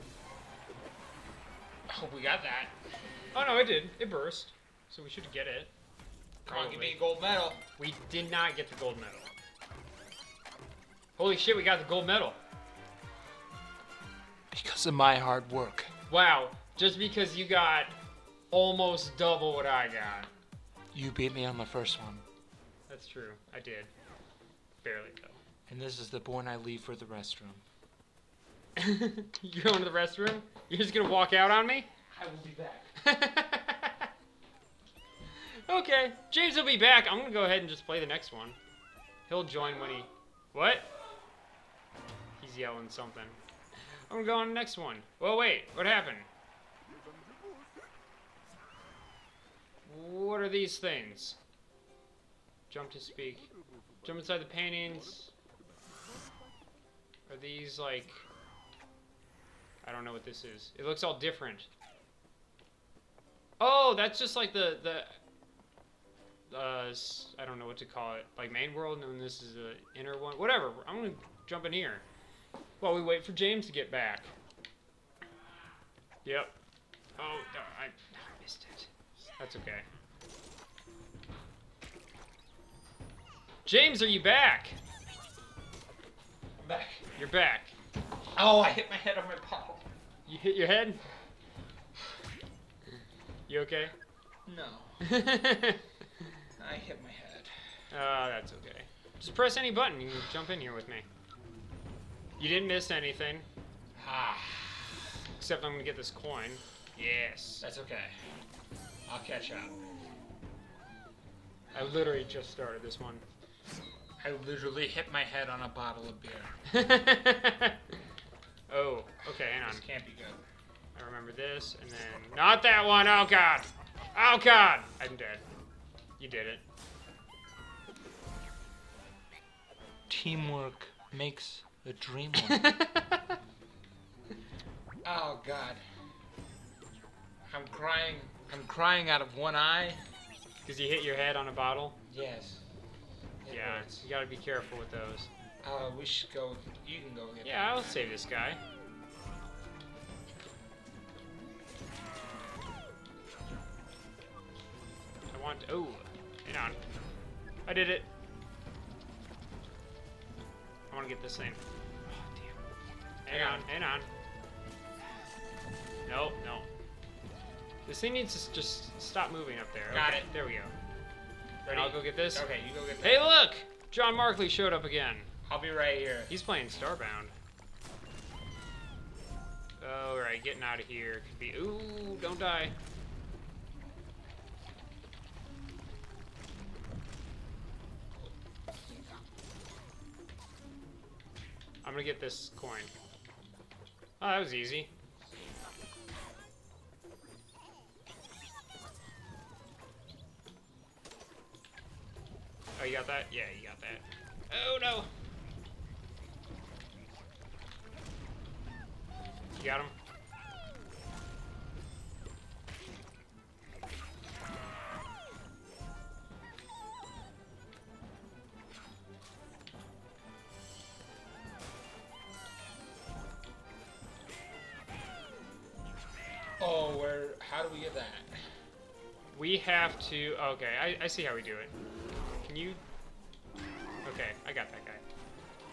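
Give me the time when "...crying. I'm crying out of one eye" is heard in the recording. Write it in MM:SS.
02:17.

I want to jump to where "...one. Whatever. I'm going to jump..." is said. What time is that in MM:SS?
01:10.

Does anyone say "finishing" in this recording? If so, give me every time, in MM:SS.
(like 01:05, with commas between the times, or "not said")
not said.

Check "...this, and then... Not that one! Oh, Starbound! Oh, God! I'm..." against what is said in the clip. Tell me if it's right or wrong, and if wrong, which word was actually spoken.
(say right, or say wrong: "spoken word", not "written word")
wrong: "God", not "Starbound".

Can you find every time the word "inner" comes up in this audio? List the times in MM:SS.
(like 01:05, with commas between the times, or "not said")
01:09.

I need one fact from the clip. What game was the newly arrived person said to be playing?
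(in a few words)
Starbound.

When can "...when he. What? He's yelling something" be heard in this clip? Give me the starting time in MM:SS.
00:39.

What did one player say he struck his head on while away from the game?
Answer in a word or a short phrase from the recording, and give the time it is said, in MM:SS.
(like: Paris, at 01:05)
A bottle of beer, at 01:55.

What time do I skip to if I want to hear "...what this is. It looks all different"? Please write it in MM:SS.
01:00.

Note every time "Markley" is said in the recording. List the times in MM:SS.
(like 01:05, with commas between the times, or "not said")
02:54.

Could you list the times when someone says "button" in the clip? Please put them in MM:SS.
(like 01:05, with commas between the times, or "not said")
01:39.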